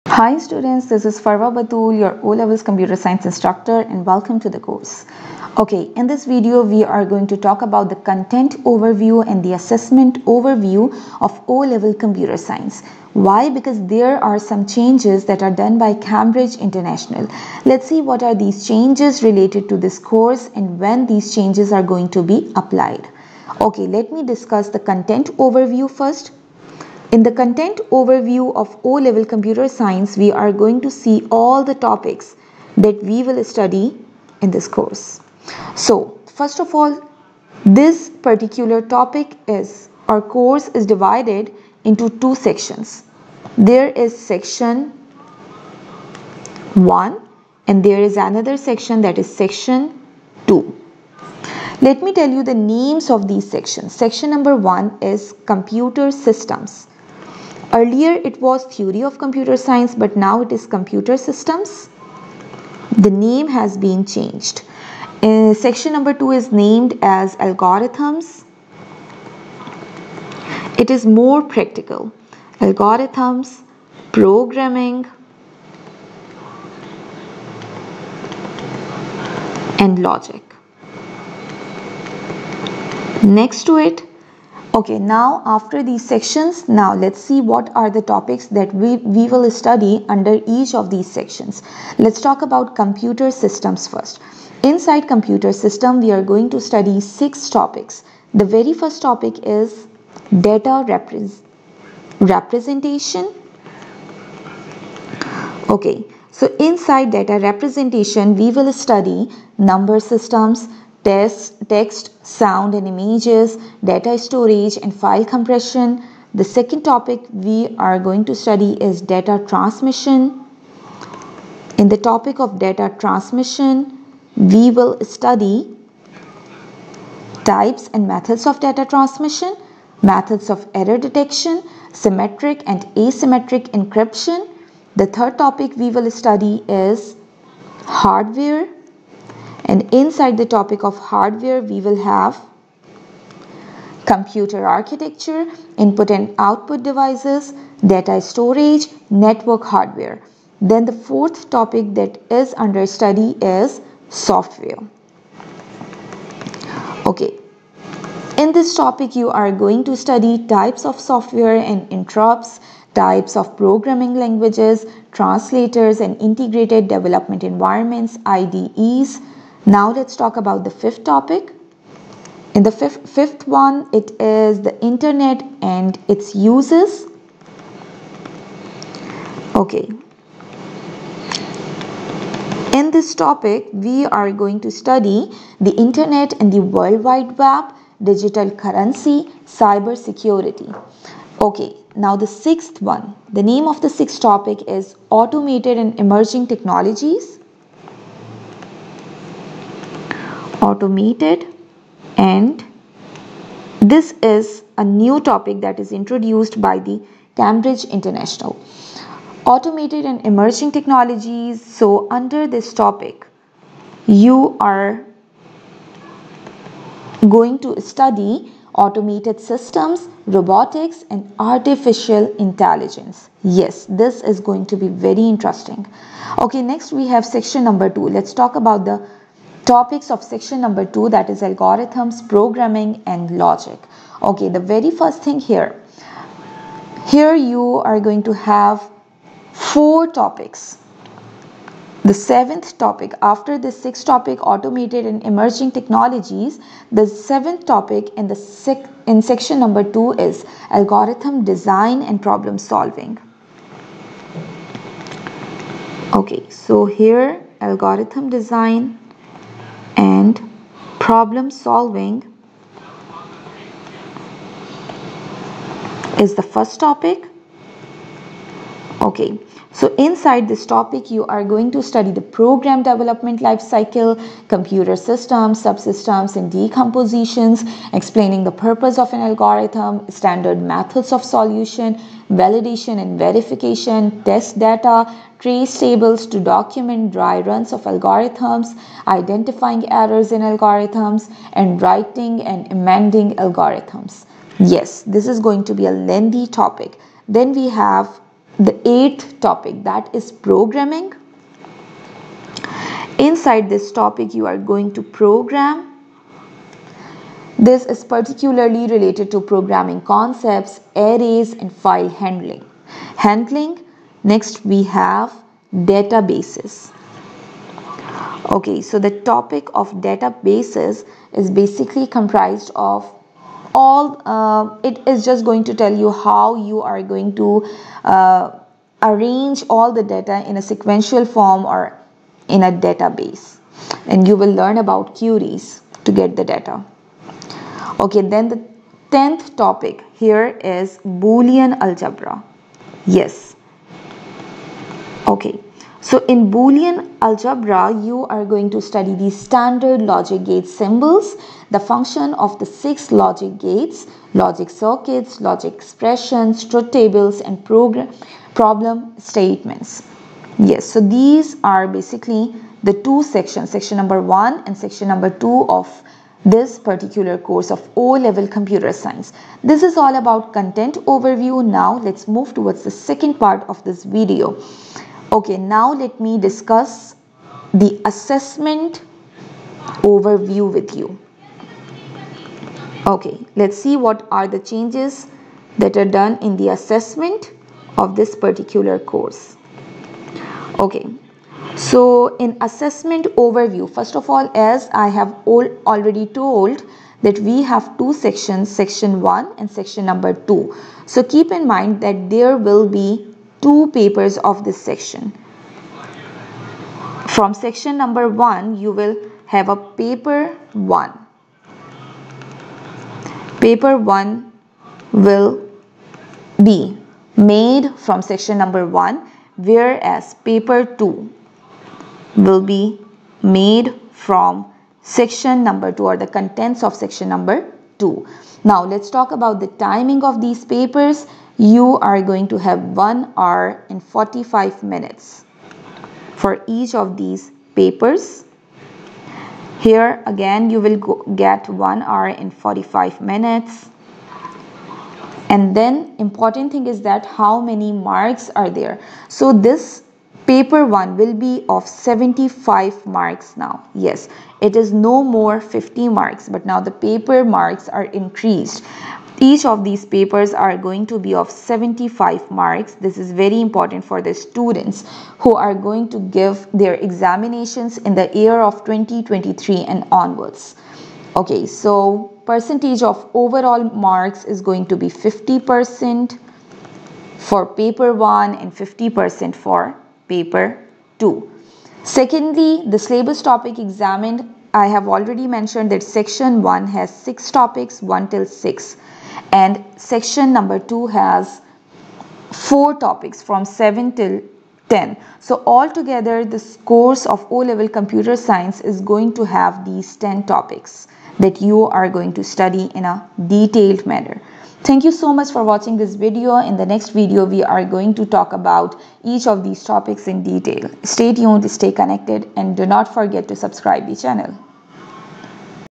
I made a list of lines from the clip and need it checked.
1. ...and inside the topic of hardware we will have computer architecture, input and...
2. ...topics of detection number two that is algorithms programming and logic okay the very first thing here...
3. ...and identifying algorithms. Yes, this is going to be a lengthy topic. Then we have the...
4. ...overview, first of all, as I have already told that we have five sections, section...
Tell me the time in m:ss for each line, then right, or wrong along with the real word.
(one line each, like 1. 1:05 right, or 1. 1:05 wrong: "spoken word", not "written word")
1. 2:19 right
2. 3:49 wrong: "section", not "detection"
3. 4:52 wrong: "amending", not "identifying"
4. 6:33 wrong: "two", not "five".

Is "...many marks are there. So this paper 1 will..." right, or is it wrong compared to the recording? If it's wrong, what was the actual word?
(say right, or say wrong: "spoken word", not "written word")
right.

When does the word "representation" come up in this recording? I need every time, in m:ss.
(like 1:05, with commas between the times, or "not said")
1:40, 1:47.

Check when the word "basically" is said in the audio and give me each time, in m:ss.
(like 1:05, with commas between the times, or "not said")
5:21, 6:01.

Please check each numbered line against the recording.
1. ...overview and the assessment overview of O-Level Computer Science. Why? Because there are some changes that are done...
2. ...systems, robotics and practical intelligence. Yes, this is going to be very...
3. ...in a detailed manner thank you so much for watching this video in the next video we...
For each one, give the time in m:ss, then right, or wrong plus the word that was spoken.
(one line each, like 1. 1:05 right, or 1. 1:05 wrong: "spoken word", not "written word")
1. 0:08 right
2. 3:39 wrong: "artificial", not "practical"
3. 8:22 right.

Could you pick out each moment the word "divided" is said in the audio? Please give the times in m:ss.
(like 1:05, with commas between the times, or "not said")
0:40.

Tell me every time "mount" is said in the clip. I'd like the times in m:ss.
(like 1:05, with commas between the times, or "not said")
not said.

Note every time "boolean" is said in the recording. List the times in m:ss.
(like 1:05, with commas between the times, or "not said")
5:41, 5:46.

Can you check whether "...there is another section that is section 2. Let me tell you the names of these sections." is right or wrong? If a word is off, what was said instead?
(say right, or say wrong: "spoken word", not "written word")
right.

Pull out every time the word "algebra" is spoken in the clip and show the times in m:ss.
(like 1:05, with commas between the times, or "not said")
5:41, 5:47.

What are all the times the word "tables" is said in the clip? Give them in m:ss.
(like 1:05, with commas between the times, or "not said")
4:45, 5:56.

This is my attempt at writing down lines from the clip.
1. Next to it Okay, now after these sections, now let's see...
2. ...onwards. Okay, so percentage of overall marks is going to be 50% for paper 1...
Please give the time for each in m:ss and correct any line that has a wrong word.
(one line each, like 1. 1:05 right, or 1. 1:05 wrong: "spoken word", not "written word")
1. 1:23 right
2. 7:50 right.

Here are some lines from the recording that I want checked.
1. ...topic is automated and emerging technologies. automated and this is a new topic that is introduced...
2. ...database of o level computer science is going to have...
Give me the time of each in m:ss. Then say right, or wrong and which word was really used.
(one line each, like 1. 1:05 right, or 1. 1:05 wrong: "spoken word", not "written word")
1. 3:14 right
2. 8:16 wrong: "course", not "database".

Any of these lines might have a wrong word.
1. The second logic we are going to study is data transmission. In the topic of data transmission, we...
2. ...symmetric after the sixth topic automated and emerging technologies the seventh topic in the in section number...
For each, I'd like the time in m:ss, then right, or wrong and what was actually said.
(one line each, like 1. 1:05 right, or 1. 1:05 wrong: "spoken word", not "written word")
1. 1:56 wrong: "topic", not "logic"
2. 4:02 wrong: "topic", not "symmetric".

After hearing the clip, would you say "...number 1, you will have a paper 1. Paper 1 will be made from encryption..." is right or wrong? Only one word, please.
wrong.